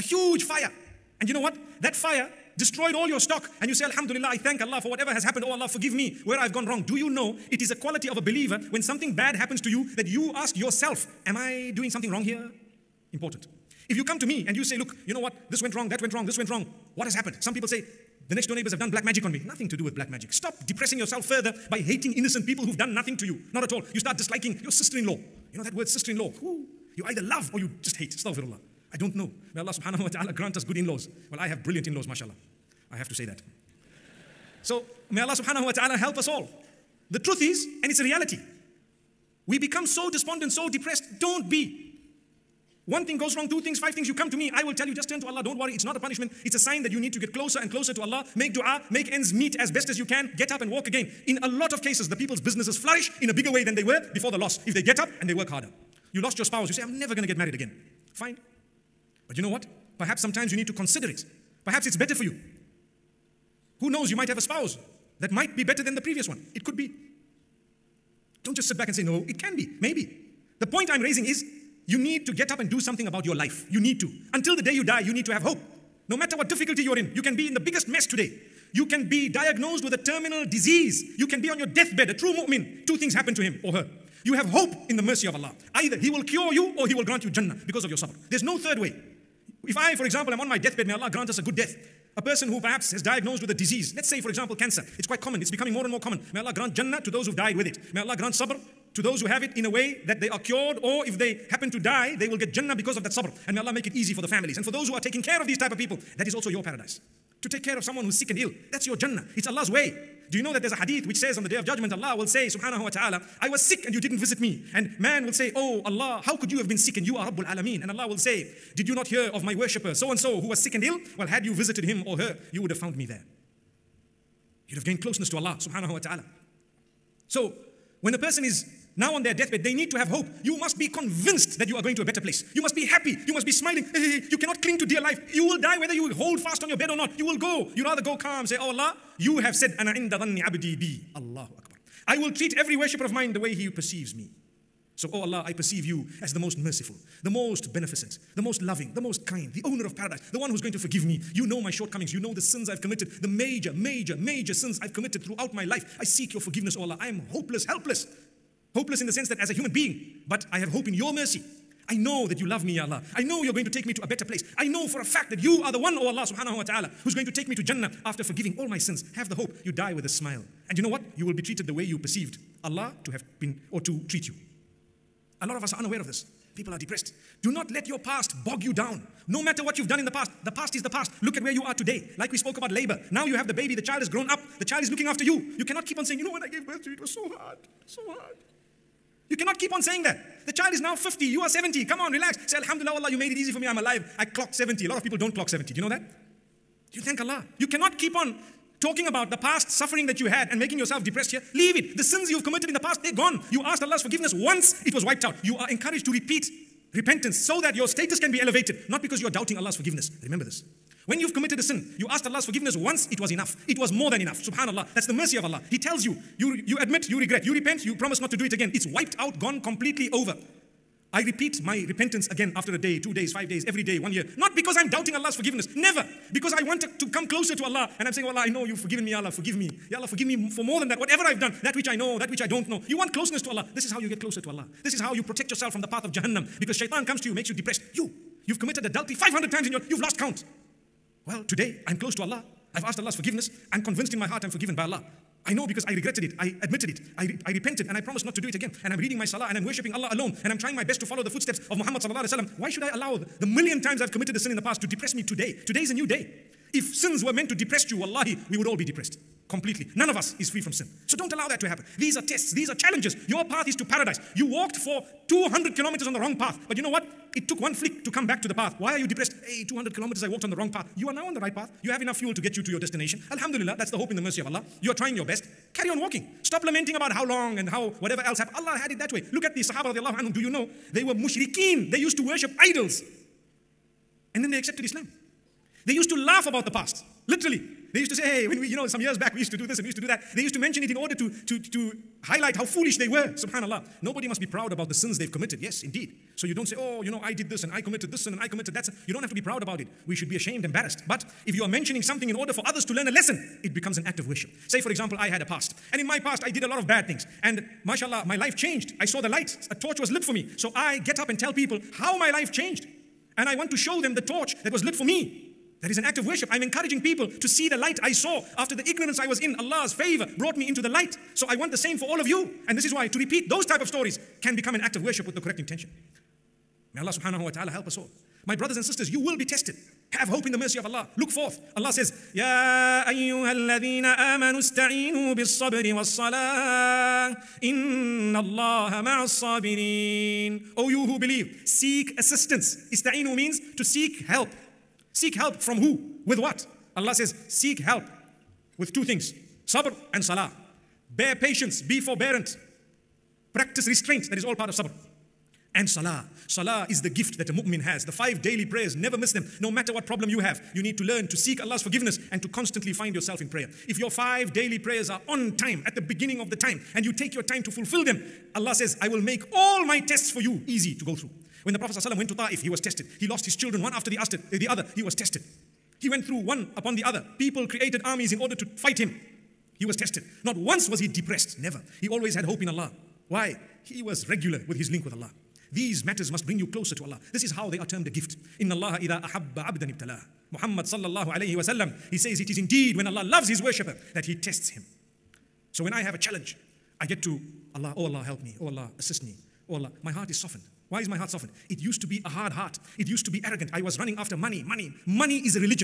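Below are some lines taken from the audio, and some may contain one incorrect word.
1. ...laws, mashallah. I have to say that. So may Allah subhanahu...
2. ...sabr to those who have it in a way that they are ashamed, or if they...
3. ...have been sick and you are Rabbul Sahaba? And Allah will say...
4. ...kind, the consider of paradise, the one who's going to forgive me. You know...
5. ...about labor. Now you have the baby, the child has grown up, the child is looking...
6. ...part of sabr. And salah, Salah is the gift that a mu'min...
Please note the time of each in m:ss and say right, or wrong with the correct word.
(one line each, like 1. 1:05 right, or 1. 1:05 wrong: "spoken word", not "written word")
1. 0:31 right
2. 1:38 wrong: "cured", not "ashamed"
3. 1:56 wrong: "Alameen", not "Sahaba"
4. 2:29 wrong: "owner", not "consider"
5. 3:02 right
6. 5:54 right.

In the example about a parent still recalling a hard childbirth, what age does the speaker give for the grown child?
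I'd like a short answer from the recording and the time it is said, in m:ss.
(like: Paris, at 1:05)
50, at 3:10.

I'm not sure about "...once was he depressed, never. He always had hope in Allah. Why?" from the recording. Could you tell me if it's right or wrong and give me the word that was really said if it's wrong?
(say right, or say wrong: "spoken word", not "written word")
right.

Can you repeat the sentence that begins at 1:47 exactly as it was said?
To take care of someone who's sick and ill, that's your Jannah.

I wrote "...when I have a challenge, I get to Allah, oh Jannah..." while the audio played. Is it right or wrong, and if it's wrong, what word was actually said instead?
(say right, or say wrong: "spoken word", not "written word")
wrong: "Allah", not "Jannah".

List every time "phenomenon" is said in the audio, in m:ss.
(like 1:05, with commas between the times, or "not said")
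not said.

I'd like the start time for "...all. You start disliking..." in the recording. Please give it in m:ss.
0:23.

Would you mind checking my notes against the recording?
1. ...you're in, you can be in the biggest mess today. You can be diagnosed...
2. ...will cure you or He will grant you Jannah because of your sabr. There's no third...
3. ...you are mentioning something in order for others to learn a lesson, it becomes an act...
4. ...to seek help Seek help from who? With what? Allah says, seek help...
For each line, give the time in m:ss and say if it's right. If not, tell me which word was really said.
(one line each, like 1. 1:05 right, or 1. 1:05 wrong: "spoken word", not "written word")
1. 1:16 right
2. 1:26 right
3. 5:01 right
4. 5:43 right.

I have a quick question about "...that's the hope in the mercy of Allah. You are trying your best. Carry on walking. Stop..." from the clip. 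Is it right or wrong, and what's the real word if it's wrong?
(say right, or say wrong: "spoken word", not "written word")
right.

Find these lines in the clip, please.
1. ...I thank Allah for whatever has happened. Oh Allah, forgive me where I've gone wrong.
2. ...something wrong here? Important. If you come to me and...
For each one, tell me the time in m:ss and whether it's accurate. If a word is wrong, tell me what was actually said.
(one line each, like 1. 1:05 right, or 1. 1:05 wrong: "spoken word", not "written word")
1. 0:04 right
2. 0:11 right.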